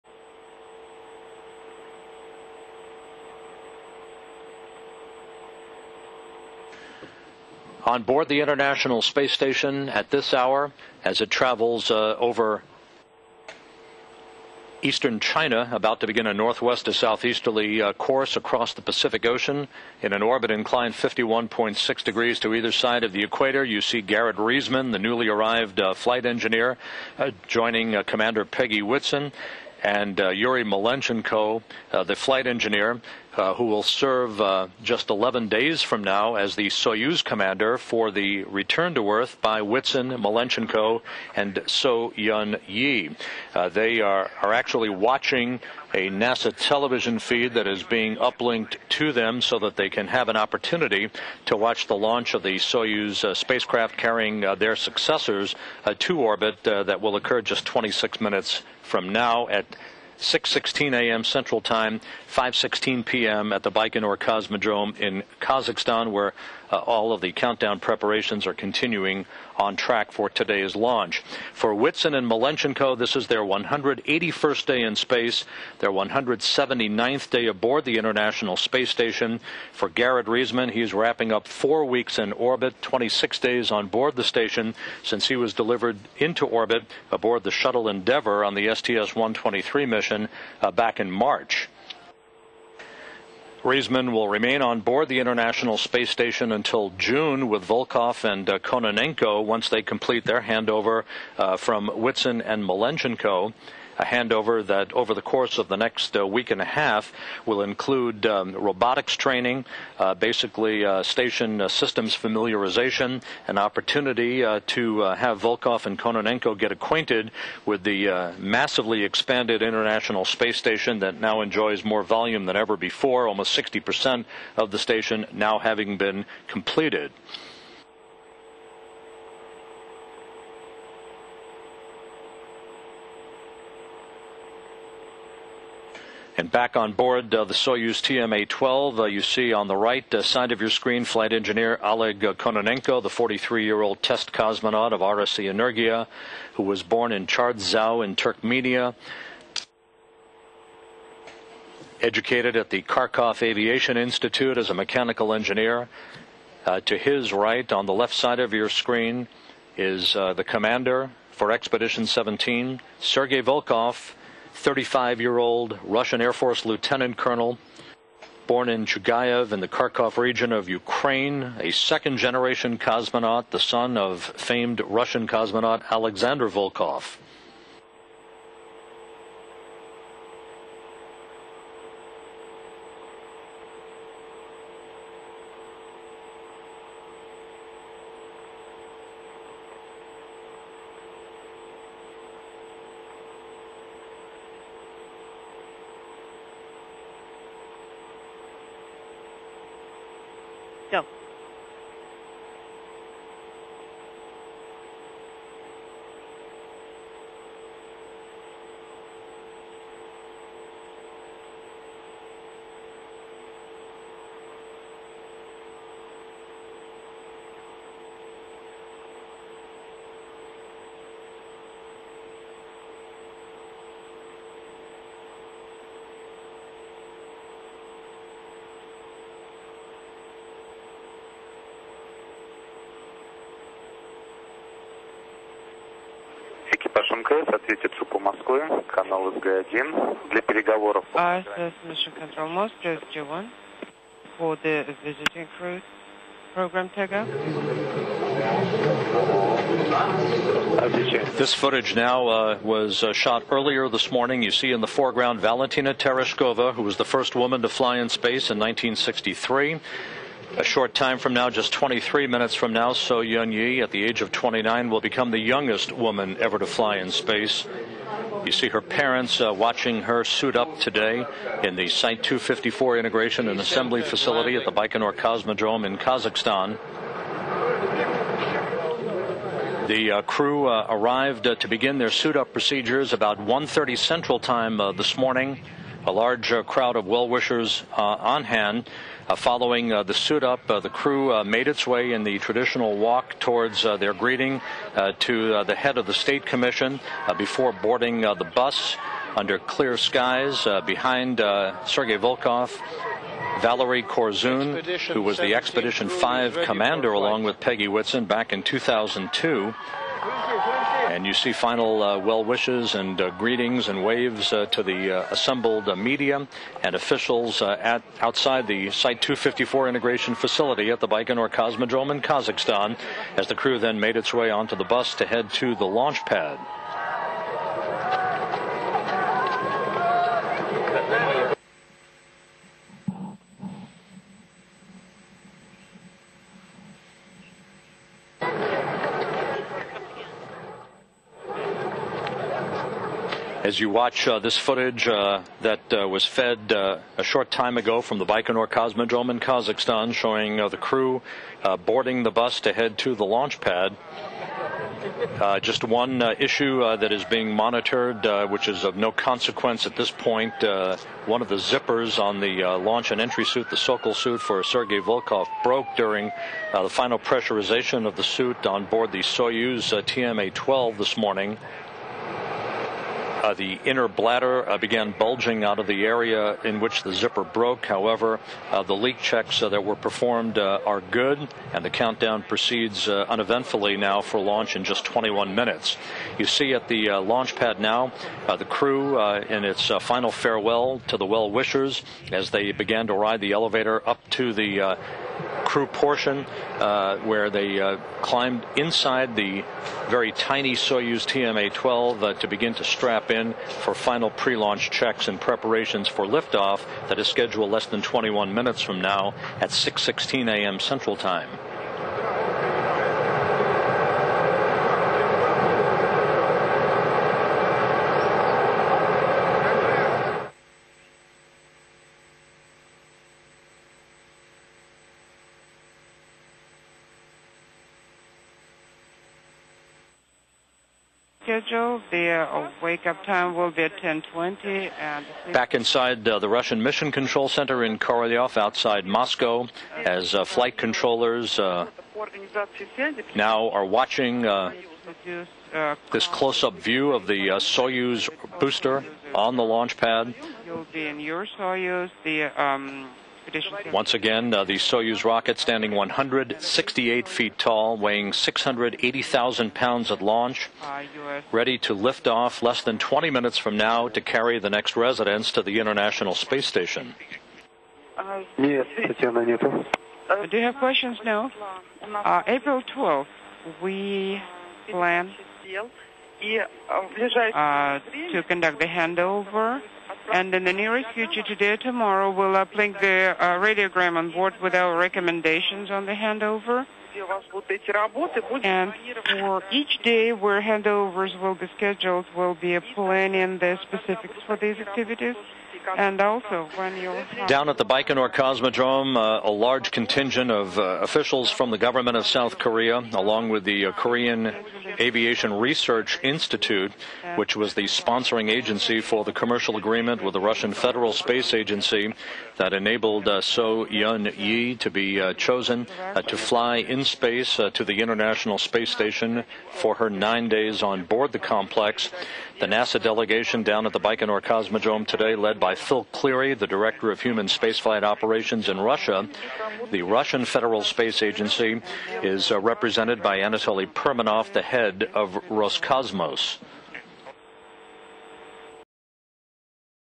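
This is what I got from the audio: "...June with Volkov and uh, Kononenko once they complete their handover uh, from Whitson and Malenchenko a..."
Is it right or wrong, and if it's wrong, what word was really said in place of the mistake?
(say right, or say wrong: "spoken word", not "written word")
right.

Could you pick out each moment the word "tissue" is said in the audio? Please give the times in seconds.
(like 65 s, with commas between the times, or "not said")
not said.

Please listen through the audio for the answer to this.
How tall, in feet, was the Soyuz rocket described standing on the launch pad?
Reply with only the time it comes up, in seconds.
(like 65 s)
455 s.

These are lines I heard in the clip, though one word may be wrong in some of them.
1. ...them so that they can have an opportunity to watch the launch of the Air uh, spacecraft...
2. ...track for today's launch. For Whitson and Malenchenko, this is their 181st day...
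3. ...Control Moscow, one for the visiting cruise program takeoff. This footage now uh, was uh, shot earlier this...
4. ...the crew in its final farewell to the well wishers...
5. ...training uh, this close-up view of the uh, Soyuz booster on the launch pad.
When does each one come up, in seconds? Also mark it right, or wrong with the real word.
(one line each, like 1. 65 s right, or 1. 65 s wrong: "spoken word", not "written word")
1. 49 s wrong: "Soyuz", not "Air"
2. 69 s right
3. 242 s right
4. 388 s right
5. 443 s wrong: "watching", not "training".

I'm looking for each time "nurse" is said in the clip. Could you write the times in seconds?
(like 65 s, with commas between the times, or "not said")
not said.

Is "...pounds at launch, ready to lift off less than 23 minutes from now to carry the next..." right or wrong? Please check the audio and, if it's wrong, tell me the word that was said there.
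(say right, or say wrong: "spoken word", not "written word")
wrong: "20", not "23".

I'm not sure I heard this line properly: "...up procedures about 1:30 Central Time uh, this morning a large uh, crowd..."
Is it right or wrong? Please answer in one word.
right.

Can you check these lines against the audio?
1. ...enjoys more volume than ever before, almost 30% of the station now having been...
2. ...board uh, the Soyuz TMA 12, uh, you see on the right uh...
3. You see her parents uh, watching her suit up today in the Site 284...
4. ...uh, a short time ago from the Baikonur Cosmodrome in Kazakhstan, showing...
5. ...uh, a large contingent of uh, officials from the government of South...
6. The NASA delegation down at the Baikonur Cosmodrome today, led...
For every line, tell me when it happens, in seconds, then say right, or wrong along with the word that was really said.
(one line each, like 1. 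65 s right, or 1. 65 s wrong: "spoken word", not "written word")
1. 121 s wrong: "60", not "30"
2. 136 s right
3. 268 s wrong: "254", not "284"
4. 346 s right
5. 499 s right
6. 522 s right.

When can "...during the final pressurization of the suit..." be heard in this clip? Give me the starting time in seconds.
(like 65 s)
365 s.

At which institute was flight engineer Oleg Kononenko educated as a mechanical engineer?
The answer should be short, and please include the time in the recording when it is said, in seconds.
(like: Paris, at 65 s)
Kharkov Aviation Institute, at 152 s.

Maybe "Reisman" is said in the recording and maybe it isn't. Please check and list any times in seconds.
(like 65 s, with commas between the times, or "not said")
24 s, 80 s, 93 s.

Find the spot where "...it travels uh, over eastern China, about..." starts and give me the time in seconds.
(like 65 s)
11 s.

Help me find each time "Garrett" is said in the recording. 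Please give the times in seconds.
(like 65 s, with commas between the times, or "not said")
24 s, 79 s.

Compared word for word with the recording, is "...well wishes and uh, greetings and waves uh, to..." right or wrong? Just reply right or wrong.
right.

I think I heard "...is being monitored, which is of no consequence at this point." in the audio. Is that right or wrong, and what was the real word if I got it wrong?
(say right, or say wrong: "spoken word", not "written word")
right.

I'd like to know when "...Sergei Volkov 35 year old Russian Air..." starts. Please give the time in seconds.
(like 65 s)
162 s.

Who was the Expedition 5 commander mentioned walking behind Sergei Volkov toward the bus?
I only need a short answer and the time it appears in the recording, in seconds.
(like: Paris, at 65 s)
Valerie Korzun, at 303 s.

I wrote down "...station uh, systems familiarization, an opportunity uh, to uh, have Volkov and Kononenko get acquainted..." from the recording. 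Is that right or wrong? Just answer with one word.
right.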